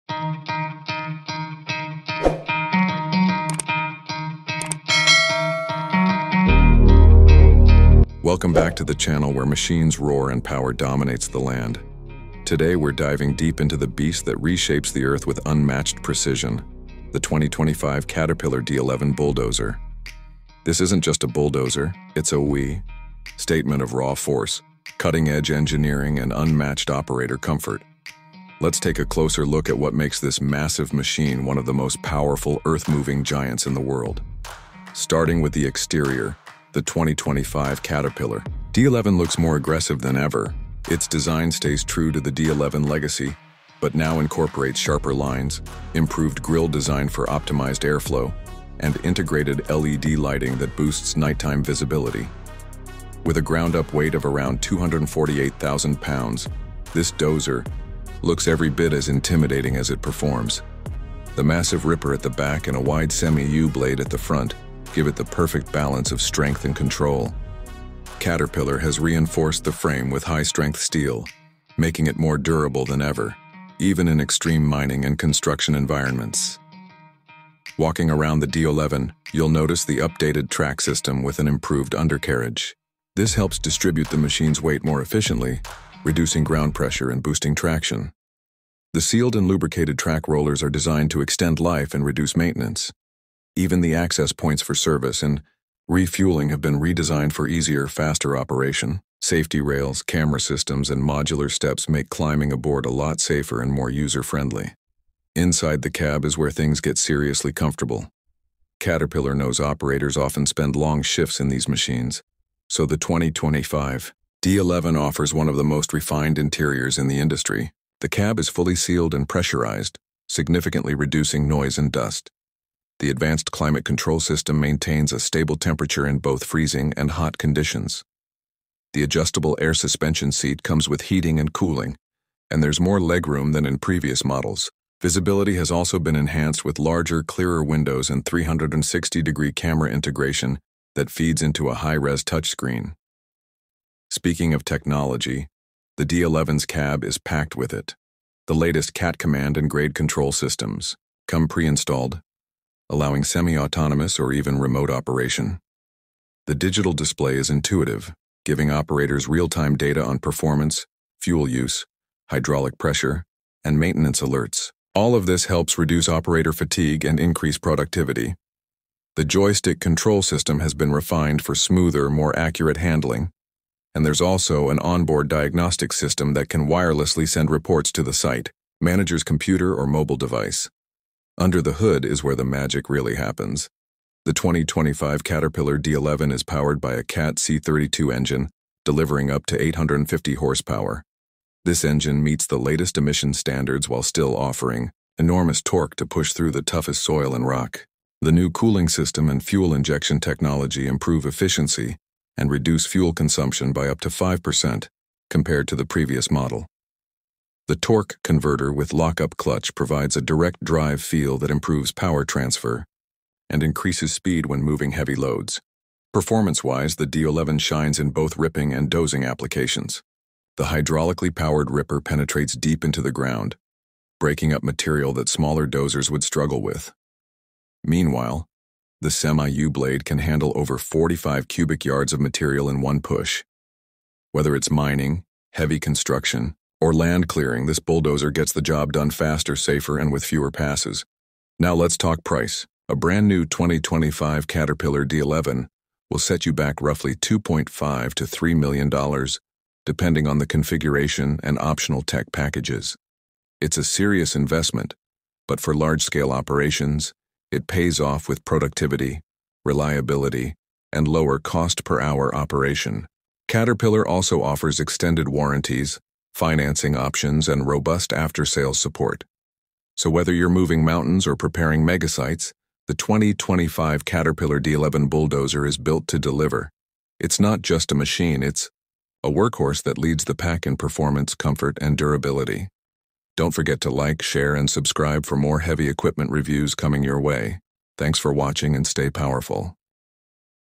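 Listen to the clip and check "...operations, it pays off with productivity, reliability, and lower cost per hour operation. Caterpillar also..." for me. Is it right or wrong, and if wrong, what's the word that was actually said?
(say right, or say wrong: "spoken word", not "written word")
right.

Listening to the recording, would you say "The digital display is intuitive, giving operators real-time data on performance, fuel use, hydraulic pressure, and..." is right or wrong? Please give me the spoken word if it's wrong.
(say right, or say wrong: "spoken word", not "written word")
right.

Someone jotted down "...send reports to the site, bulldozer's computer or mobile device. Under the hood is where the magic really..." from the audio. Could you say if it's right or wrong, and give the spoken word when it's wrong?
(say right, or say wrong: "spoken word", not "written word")
wrong: "manager", not "bulldozer".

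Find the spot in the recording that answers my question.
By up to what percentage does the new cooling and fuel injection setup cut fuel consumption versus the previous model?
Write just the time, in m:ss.
3:24.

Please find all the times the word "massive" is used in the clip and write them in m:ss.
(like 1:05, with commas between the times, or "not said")
0:30, 1:01.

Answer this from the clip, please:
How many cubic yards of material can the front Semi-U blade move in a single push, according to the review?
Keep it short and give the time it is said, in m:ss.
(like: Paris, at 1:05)
over 45 cubic yards, at 3:50.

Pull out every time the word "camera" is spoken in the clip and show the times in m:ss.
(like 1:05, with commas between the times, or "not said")
1:40, 2:19.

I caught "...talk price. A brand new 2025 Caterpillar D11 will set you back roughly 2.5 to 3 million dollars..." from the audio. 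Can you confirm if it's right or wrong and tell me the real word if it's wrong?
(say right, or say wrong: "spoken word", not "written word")
right.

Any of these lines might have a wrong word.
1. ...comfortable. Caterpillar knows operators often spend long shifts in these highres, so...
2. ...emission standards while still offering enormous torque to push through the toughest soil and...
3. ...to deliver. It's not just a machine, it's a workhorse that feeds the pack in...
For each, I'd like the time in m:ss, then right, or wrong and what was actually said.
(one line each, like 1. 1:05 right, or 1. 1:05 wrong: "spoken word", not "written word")
1. 1:47 wrong: "machines", not "highres"
2. 3:12 right
3. 4:36 wrong: "leads", not "feeds".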